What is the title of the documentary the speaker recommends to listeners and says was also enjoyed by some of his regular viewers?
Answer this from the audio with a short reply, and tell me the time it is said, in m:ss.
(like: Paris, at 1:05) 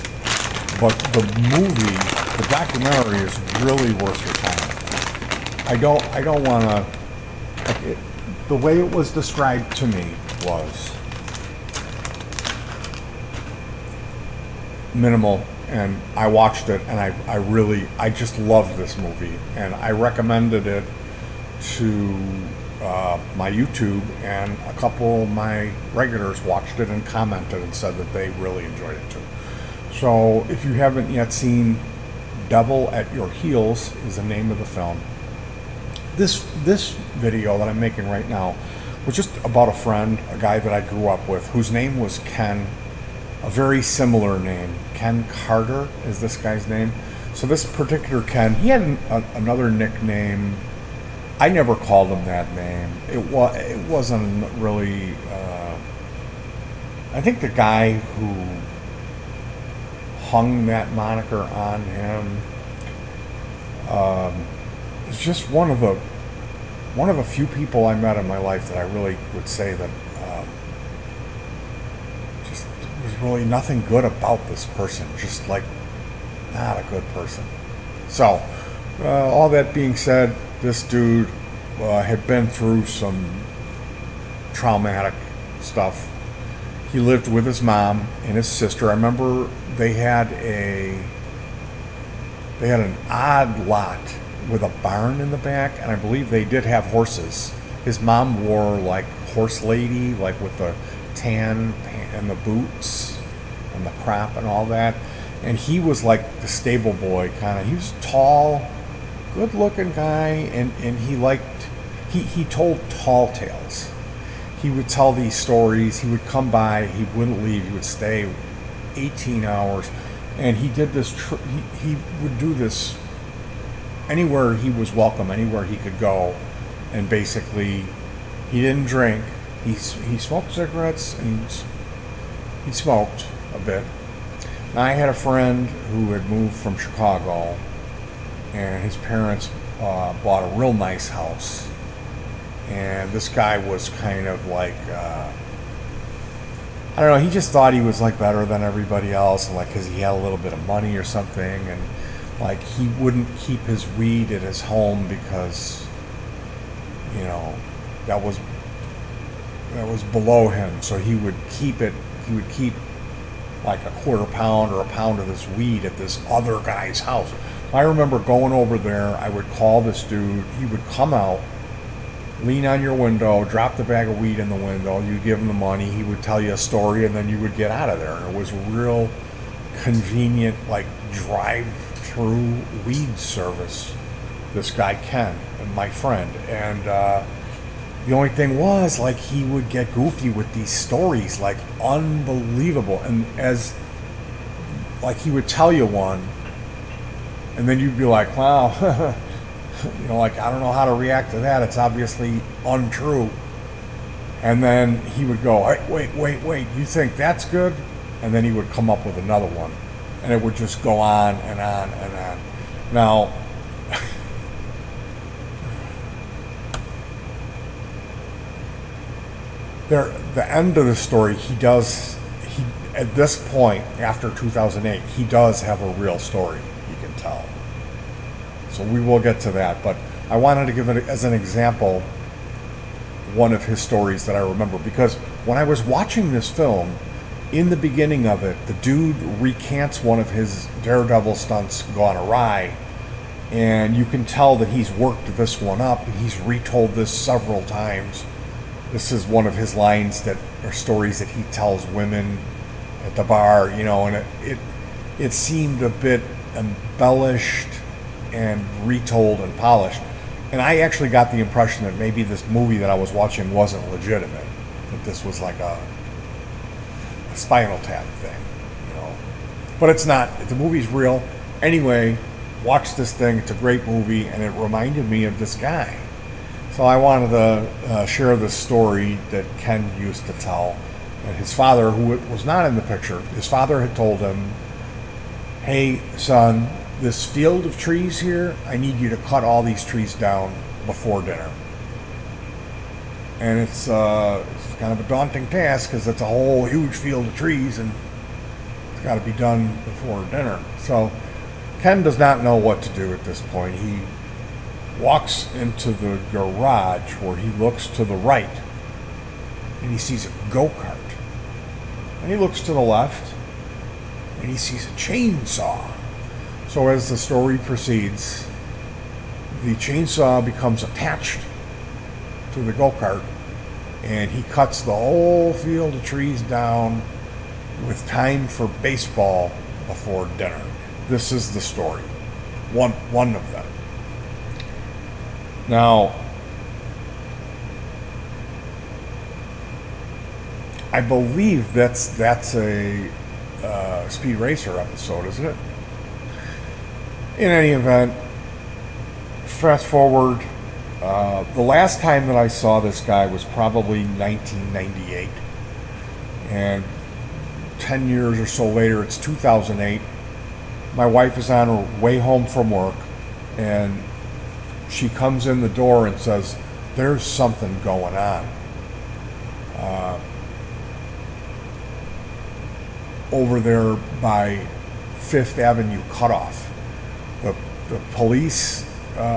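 Devil at Your Heels, at 0:32.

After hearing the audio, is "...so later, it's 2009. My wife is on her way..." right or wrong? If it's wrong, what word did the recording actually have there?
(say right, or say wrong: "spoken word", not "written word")
wrong: "2008", not "2009".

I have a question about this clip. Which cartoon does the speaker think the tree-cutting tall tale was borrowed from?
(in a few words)
Speed Racer.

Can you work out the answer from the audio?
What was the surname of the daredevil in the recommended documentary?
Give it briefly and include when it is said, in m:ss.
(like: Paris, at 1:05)
Carter, at 0:45.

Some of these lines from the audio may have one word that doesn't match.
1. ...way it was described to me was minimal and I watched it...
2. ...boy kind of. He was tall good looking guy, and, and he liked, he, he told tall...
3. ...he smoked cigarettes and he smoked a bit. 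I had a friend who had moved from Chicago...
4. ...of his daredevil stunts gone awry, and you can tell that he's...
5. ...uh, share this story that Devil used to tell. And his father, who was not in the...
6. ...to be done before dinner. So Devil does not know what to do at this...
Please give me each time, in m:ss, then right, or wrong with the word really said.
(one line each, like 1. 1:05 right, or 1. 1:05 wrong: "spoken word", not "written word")
1. 0:08 right
2. 1:46 right
3. 2:09 right
4. 4:00 right
5. 4:37 wrong: "Ken", not "Devil"
6. 4:59 wrong: "Ken", not "Devil".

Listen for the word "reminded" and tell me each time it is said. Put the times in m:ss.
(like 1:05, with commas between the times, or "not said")
4:34.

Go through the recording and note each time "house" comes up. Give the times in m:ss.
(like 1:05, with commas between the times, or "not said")
2:21, 2:46.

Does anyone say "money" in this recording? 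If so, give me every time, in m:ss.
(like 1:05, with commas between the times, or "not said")
2:30, 2:55.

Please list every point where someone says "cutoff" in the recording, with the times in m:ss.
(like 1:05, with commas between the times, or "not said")
6:16.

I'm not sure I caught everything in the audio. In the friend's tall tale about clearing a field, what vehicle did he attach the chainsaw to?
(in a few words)
Go-kart.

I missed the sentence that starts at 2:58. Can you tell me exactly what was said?
And it was real convenient, like drive through weed service.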